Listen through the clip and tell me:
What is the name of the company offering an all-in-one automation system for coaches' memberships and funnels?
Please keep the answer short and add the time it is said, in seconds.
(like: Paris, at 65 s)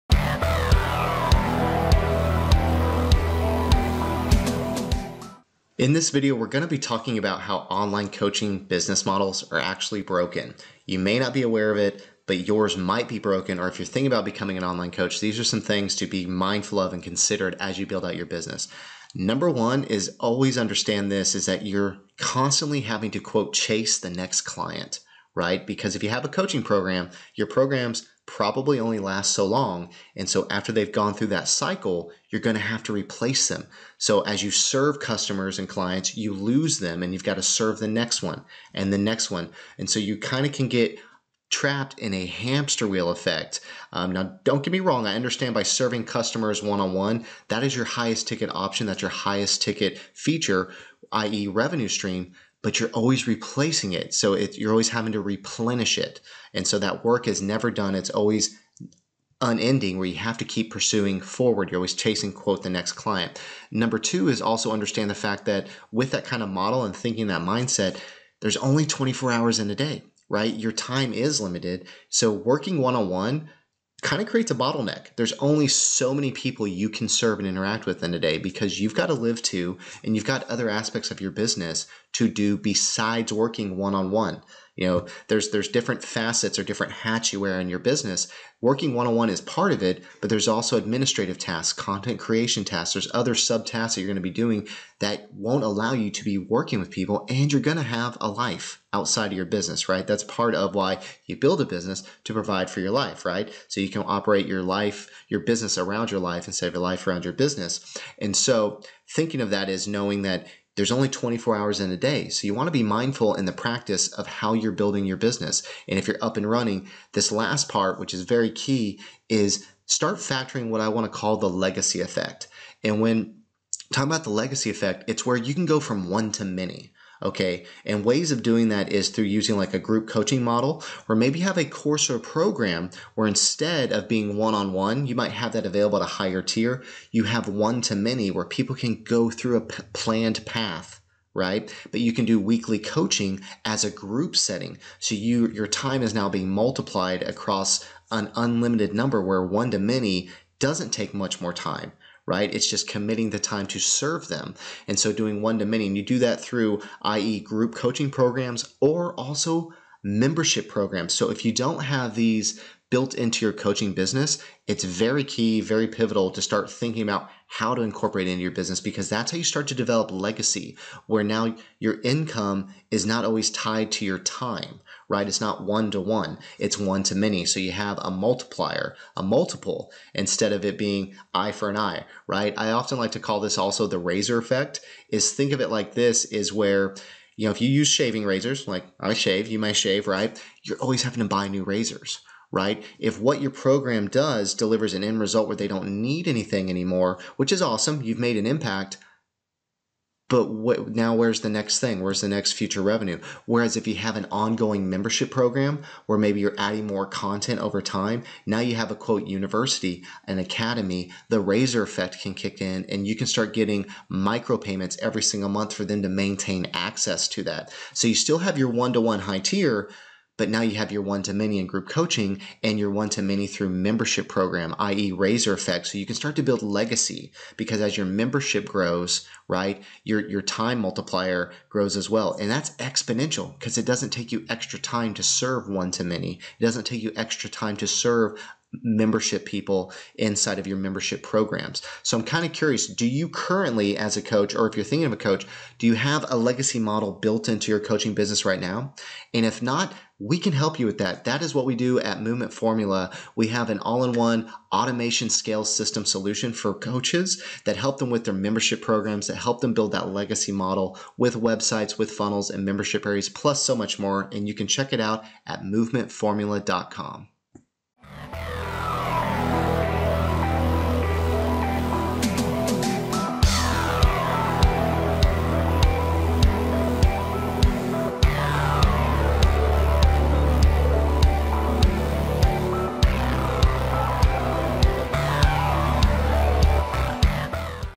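Movement Formula, at 252 s.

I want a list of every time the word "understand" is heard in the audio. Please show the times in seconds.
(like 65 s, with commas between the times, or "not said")
20 s, 45 s, 64 s.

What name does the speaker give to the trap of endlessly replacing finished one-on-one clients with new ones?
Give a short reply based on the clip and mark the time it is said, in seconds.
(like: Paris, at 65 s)
hamster wheel effect, at 42 s.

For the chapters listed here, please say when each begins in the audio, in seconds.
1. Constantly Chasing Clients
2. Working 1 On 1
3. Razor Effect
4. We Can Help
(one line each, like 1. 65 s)
1. 25 s
2. 67 s
3. 185 s
4. 250 s.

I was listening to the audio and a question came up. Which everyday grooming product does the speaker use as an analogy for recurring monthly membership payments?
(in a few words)
shaving razors.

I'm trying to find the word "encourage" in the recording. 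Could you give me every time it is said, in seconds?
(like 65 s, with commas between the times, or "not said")
not said.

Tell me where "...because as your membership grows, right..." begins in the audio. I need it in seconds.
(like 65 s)
227 s.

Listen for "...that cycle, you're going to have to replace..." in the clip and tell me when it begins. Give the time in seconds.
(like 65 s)
31 s.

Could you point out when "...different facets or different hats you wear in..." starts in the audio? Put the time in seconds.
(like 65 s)
85 s.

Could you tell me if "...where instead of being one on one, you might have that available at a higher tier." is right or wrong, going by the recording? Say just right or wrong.
right.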